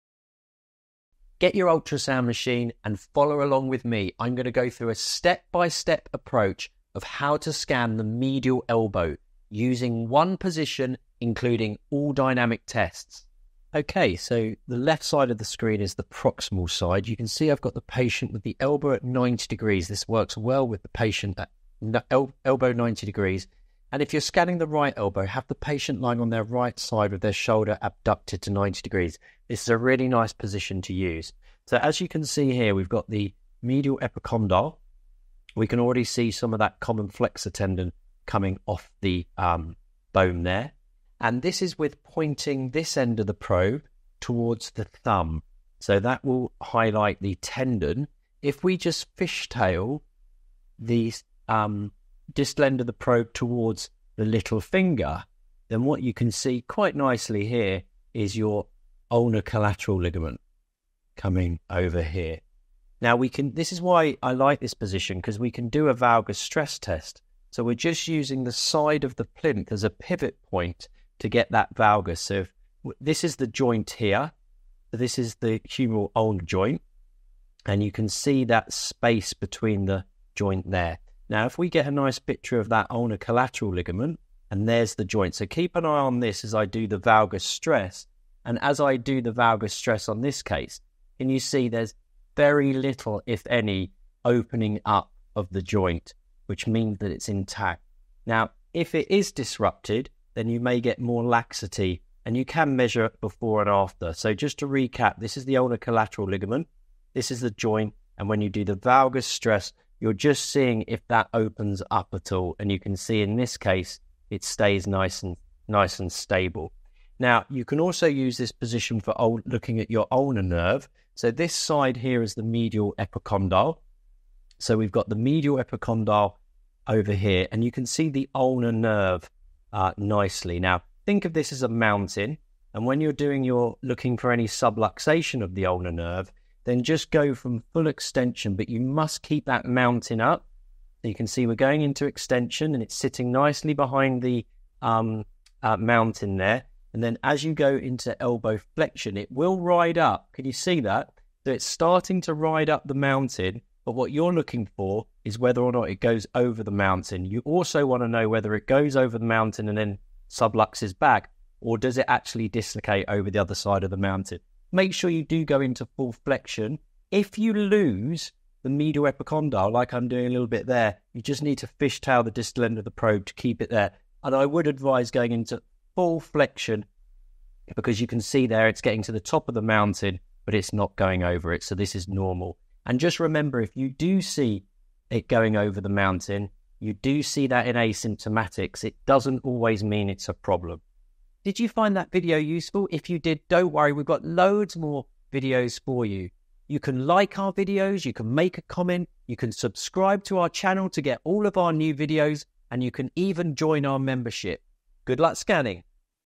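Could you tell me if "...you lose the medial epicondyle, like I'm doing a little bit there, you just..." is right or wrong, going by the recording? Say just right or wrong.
right.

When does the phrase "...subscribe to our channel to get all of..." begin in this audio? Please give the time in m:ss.
3:19.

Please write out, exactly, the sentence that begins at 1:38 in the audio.
Now, if it is disrupted, then you may get more laxity and you can measure before and after.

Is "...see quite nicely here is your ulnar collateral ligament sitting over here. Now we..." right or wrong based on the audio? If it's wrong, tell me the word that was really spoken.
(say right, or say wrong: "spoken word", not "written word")
wrong: "coming", not "sitting".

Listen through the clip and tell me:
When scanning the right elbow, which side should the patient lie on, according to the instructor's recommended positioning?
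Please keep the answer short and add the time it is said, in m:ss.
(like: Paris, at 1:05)
Right side, at 0:26.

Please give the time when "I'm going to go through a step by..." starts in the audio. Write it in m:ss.
0:04.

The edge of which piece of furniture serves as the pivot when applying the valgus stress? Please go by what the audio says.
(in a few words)
The plinth.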